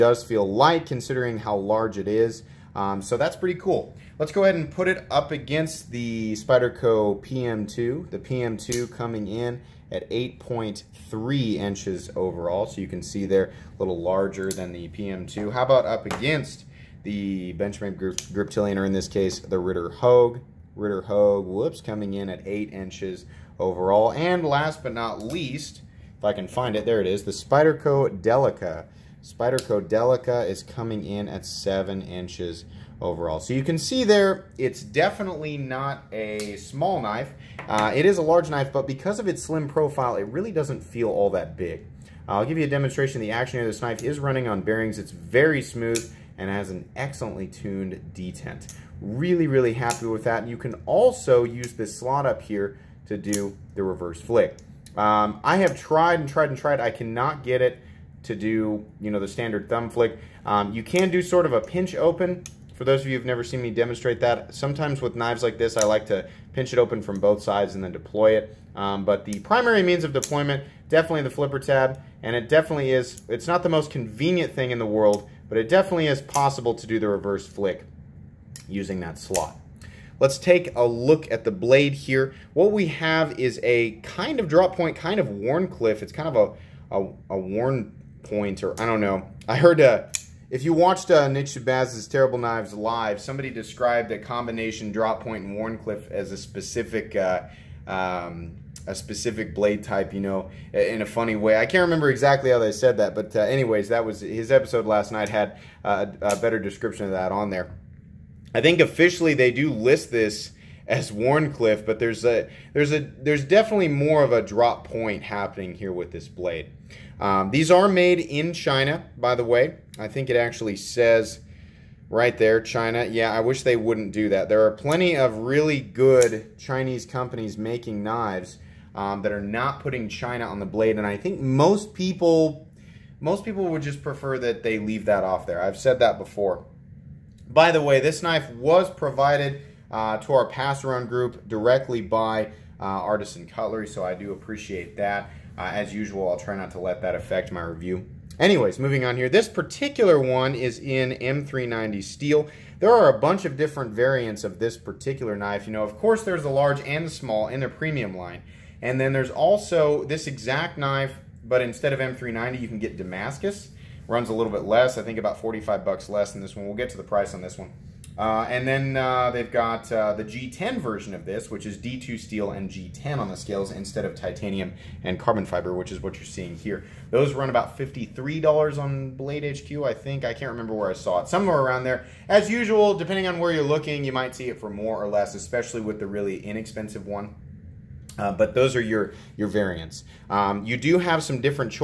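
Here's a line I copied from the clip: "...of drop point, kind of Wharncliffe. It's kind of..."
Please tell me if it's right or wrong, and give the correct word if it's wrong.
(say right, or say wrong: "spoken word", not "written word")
right.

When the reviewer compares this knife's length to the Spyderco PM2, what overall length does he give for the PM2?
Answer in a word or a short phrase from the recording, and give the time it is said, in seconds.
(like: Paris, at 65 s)
8.3 inches, at 10 s.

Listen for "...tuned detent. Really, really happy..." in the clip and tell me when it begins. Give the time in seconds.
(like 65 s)
47 s.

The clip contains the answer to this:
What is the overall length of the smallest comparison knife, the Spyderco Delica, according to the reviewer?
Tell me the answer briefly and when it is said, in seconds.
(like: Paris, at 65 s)
7 inches, at 31 s.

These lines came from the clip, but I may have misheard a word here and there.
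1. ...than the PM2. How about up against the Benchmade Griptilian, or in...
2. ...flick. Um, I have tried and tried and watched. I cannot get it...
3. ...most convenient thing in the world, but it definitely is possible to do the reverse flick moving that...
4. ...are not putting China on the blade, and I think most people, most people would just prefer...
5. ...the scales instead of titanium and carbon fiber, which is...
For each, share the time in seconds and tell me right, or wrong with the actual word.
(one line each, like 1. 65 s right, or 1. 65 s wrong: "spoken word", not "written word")
1. 14 s right
2. 54 s wrong: "tried", not "watched"
3. 73 s wrong: "using", not "moving"
4. 129 s right
5. 173 s right.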